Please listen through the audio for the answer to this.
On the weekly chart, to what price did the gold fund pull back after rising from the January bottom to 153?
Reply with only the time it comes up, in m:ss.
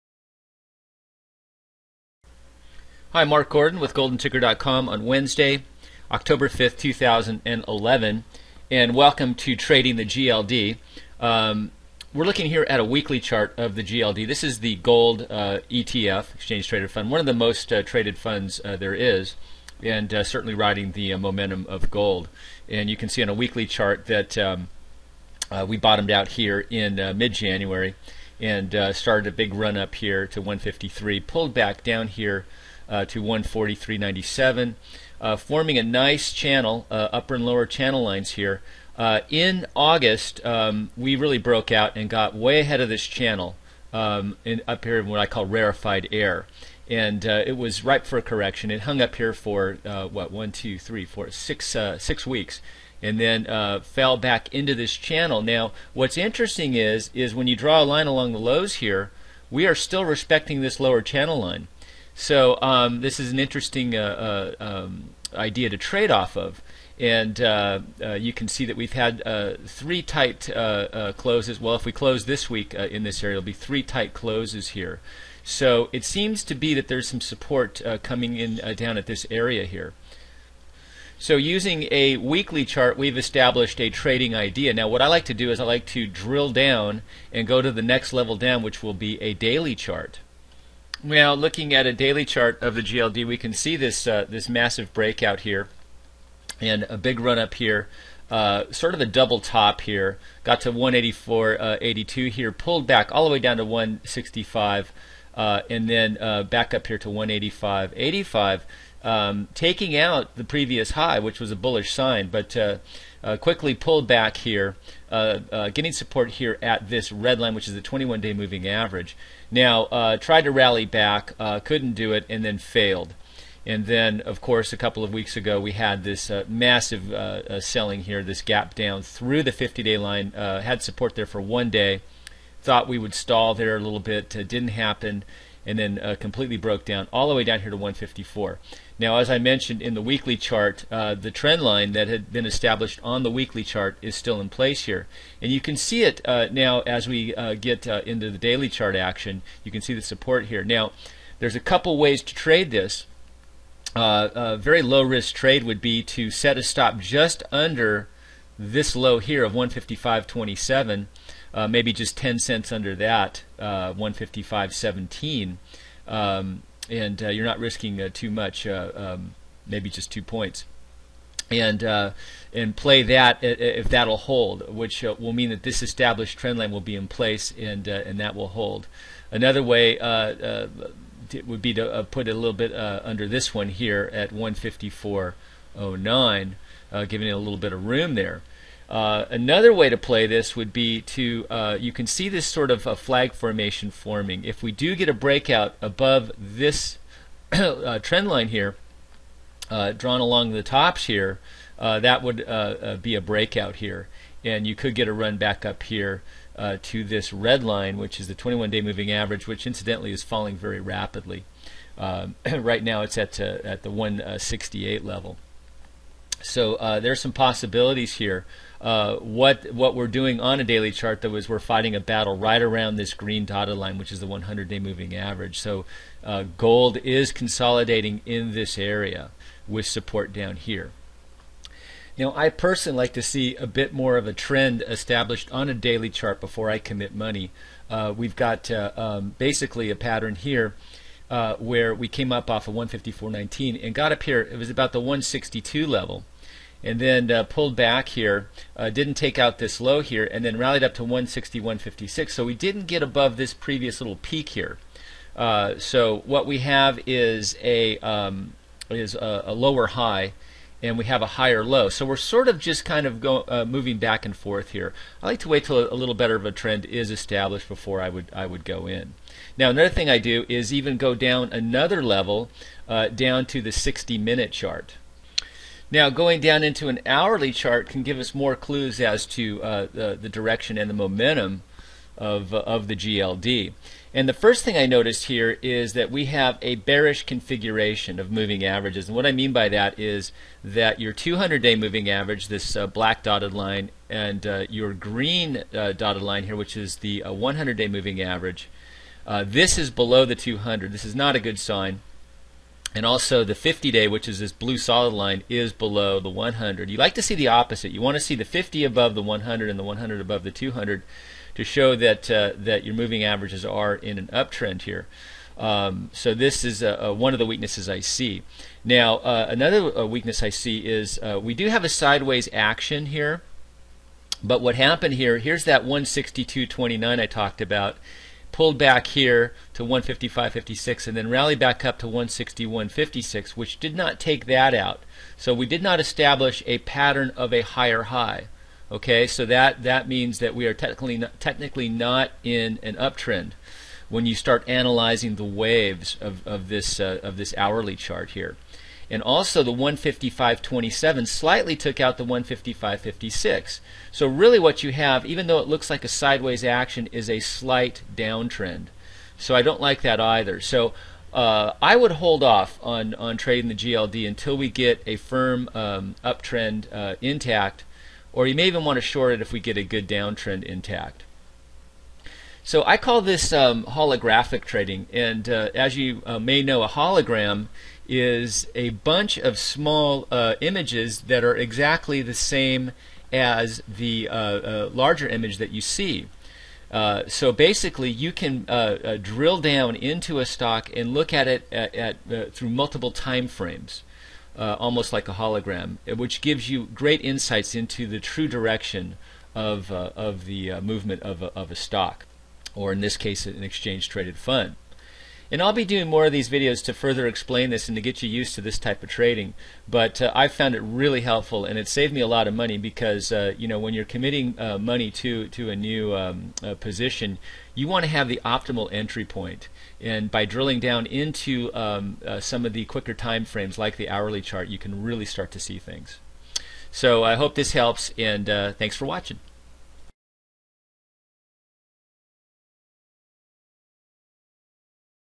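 0:33.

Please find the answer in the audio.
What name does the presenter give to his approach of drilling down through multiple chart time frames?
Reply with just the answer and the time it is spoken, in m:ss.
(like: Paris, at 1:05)
holofractal trading, at 6:13.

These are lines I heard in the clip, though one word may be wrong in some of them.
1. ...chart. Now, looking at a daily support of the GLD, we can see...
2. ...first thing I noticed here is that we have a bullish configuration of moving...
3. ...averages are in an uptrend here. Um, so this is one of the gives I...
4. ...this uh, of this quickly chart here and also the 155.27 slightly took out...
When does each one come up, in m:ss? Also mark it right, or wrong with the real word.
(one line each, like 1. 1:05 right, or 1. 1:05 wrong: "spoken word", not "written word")
1. 1:29 wrong: "chart", not "support"
2. 4:44 wrong: "bearish", not "bullish"
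3. 5:13 wrong: "weaknesses", not "gives"
4. 5:46 wrong: "hourly", not "quickly".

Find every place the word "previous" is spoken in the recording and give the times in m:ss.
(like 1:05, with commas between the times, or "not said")
1:50, 4:13.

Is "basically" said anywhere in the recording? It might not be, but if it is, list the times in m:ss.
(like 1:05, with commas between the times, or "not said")
3:59, 6:27.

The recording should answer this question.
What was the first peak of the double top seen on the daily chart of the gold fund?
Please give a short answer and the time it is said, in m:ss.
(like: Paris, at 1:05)
184.82, at 1:40.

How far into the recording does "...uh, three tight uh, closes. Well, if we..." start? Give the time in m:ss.
1:09.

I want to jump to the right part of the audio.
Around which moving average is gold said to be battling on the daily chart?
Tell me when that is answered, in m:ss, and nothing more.
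3:44.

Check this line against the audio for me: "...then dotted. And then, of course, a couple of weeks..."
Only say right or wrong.
wrong.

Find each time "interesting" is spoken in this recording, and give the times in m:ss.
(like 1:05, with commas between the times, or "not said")
0:56, 1:03.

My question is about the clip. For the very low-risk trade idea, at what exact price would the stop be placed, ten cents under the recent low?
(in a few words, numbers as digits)
155.17.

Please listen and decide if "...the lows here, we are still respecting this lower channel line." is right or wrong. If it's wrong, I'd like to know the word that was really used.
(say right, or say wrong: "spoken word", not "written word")
right.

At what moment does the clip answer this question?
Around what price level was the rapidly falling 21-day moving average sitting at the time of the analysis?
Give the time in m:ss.
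3:33.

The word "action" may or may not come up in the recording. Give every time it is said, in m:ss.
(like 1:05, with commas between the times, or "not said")
2:28, 5:22, 5:56.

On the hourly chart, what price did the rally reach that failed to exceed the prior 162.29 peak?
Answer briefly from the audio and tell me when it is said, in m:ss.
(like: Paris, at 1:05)
161.56, at 5:32.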